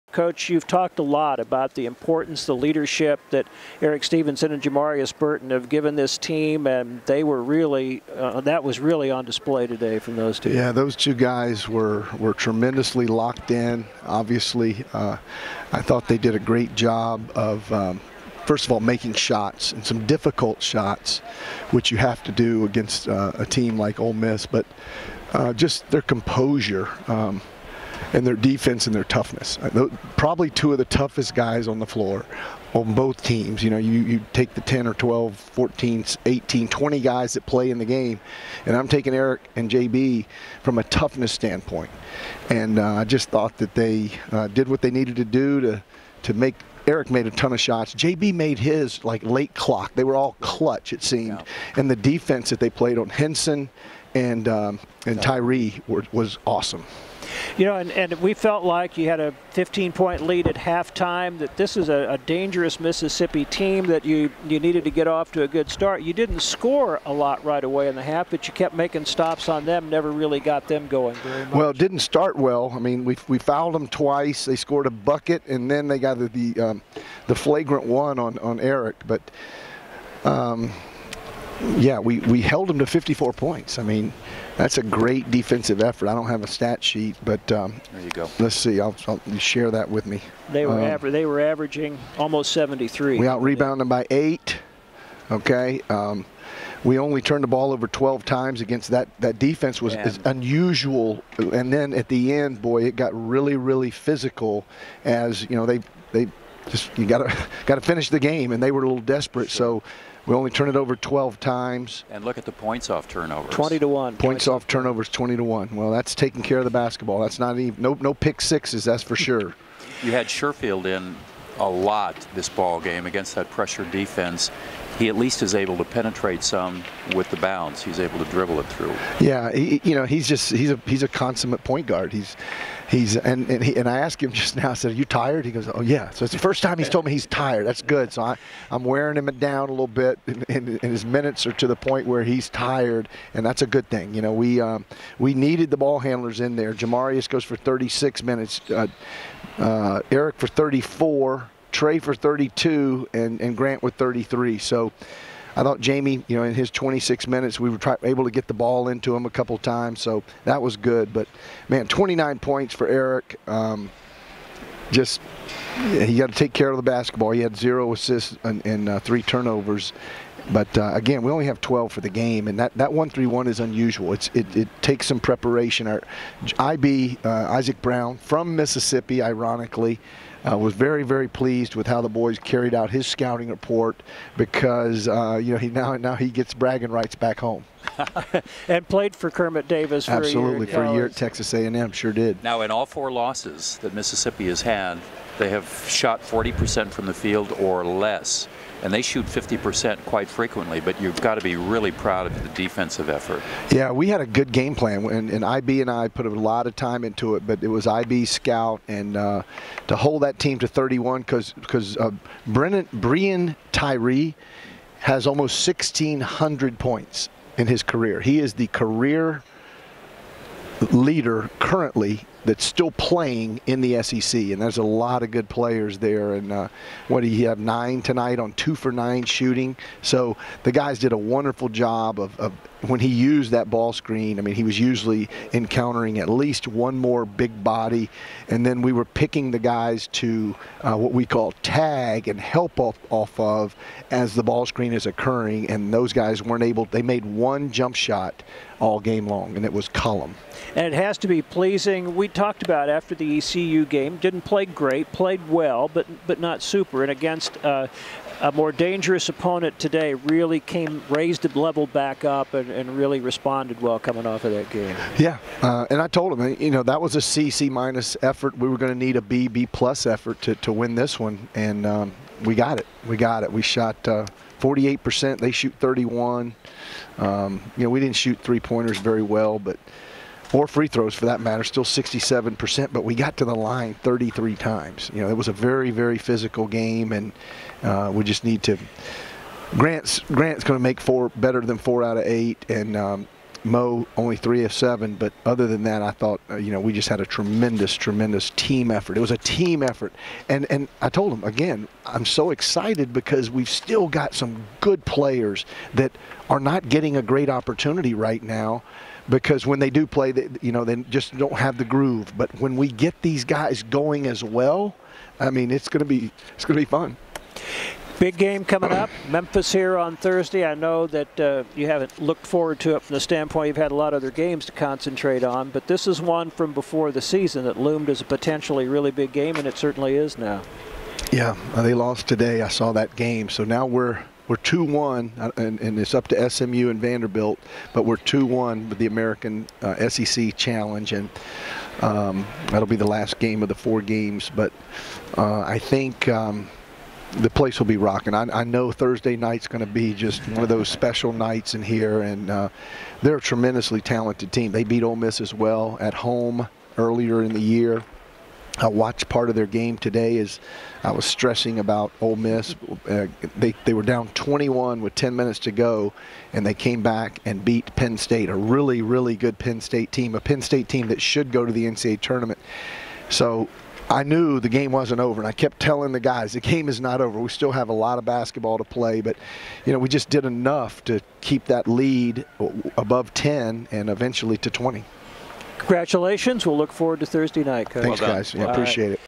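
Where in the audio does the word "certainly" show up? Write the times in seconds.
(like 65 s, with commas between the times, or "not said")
329 s.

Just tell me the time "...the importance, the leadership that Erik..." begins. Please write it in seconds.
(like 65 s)
1 s.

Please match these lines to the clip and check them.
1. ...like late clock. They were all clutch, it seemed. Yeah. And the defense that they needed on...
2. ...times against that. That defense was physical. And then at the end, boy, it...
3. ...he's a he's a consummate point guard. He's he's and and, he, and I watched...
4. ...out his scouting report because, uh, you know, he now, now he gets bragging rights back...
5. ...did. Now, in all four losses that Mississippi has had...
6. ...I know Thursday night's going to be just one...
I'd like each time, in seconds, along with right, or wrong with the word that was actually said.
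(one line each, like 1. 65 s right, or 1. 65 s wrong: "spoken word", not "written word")
1. 49 s wrong: "played", not "needed"
2. 98 s wrong: "unusual", not "physical"
3. 130 s wrong: "asked", not "watched"
4. 182 s right
5. 192 s right
6. 348 s right.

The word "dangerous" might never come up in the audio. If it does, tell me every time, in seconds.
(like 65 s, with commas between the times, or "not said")
62 s, 258 s.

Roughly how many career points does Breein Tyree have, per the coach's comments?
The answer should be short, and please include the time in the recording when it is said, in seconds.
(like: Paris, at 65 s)
1,600, at 215 s.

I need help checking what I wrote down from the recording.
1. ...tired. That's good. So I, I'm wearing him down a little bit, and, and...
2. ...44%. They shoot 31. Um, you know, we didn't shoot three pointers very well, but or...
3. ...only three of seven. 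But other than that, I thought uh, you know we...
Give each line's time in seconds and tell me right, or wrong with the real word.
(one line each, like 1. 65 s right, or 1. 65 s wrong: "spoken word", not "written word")
1. 137 s right
2. 274 s wrong: "48", not "44"
3. 294 s right.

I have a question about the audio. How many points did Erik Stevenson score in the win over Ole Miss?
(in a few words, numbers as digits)
29.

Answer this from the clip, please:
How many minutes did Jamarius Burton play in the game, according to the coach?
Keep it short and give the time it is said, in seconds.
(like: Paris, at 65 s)
36, at 147 s.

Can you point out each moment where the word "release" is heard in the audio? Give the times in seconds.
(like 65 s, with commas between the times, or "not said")
not said.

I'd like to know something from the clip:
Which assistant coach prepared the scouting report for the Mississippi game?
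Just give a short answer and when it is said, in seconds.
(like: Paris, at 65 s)
Isaac Brown, at 177 s.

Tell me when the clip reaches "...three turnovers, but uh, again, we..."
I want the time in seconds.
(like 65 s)
168 s.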